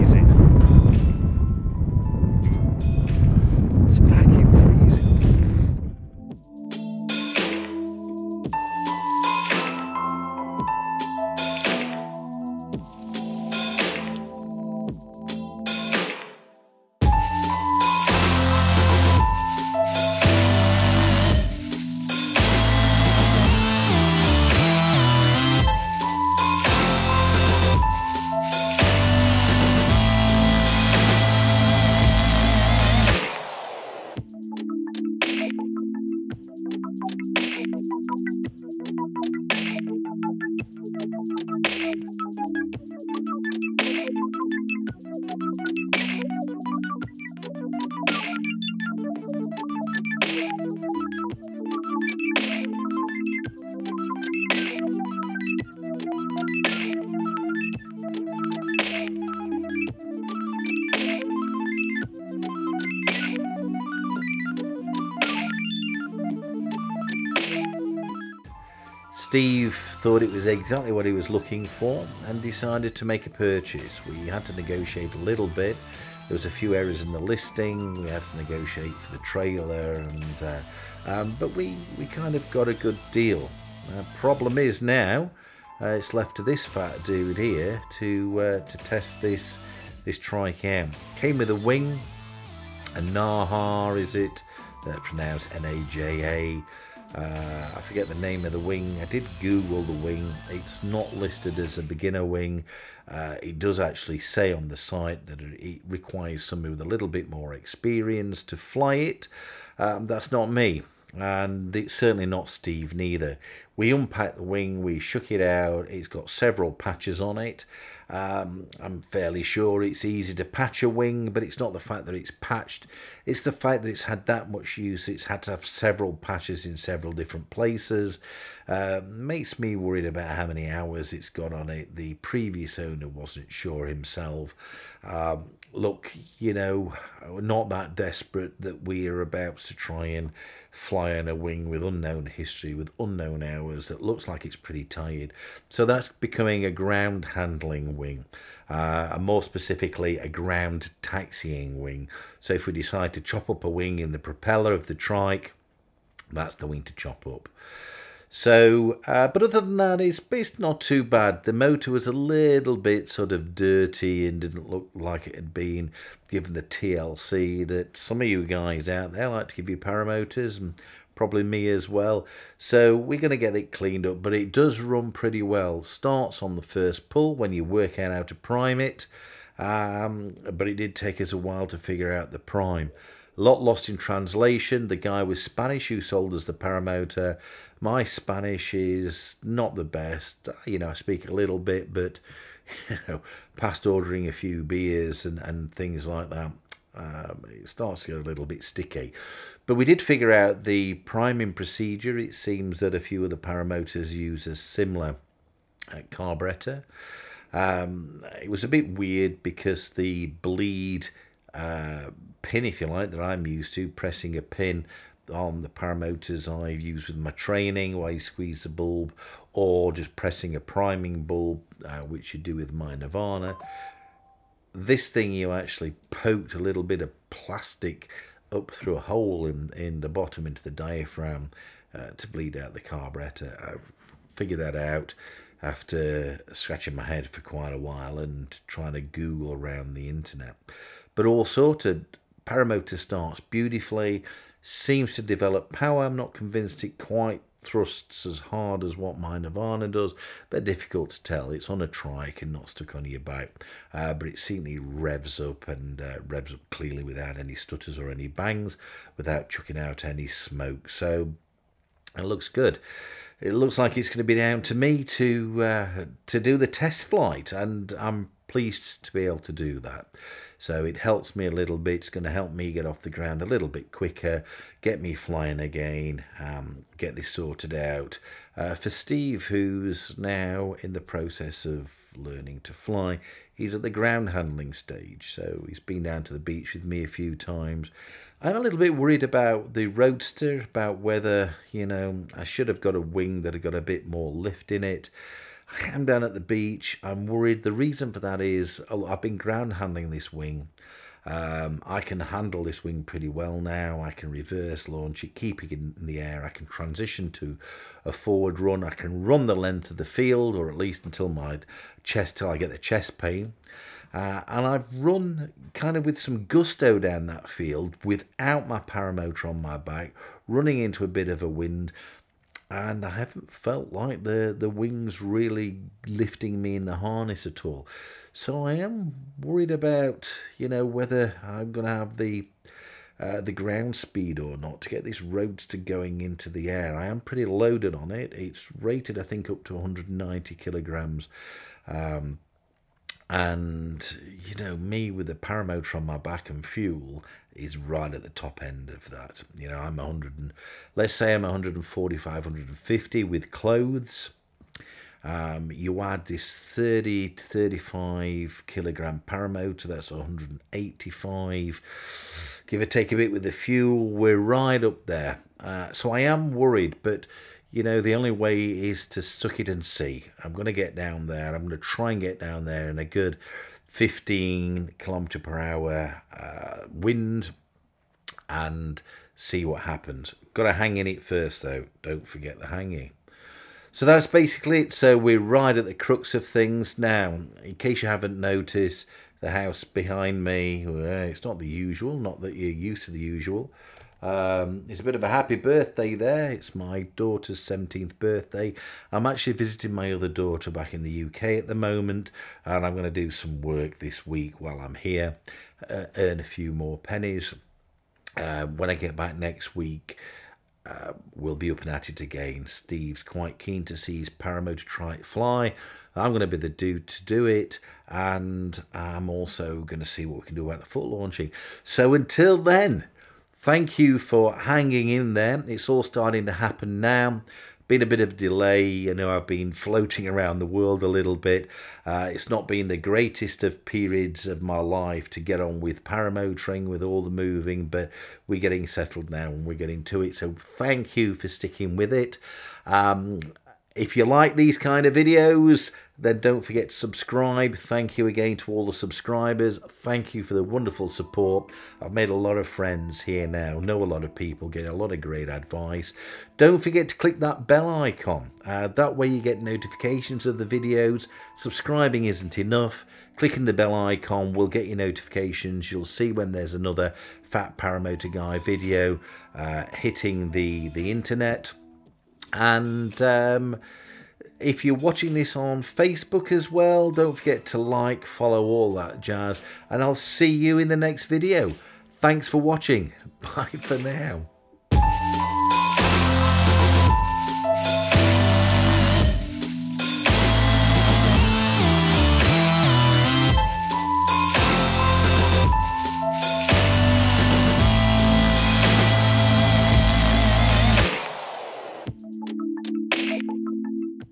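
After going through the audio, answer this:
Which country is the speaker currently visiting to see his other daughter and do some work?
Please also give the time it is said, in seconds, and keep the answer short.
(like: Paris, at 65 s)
UK, at 401 s.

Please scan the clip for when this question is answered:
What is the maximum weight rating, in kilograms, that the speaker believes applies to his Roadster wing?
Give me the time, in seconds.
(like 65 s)
339 s.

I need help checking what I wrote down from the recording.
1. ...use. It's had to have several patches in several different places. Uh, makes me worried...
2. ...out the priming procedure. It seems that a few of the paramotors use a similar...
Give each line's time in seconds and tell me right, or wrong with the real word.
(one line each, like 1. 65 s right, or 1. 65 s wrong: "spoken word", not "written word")
1. 124 s right
2. 200 s right.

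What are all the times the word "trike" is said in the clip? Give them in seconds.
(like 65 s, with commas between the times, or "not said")
154 s, 251 s, 414 s.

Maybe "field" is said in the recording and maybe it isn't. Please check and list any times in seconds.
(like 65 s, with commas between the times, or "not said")
310 s, 317 s.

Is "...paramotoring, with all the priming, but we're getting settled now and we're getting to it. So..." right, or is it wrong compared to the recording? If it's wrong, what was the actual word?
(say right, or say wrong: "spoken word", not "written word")
wrong: "moving", not "priming".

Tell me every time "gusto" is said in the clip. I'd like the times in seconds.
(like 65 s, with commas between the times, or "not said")
316 s.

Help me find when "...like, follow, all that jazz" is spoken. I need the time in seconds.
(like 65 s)
477 s.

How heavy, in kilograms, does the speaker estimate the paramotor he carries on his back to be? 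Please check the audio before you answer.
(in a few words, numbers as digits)
30 to 35 kilograms.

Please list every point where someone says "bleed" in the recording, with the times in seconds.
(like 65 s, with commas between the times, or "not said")
210 s, 232 s.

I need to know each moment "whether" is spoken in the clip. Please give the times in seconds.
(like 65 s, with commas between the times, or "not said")
290 s, 330 s.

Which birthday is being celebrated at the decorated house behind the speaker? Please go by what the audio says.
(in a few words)
17th.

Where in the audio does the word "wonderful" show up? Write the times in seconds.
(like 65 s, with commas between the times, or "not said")
450 s.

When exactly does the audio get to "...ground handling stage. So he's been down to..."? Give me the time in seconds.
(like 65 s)
283 s.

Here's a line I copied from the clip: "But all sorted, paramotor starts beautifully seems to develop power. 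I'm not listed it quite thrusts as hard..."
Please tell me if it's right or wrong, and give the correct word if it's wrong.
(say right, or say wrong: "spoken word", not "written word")
wrong: "convinced", not "listed".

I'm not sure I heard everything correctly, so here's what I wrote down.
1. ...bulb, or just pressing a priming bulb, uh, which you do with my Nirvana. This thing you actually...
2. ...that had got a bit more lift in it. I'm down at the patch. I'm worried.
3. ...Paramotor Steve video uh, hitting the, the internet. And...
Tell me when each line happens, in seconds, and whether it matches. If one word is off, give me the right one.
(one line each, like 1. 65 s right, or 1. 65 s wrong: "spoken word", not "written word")
1. 218 s right
2. 293 s wrong: "beach", not "patch"
3. 467 s wrong: "Guy", not "Steve".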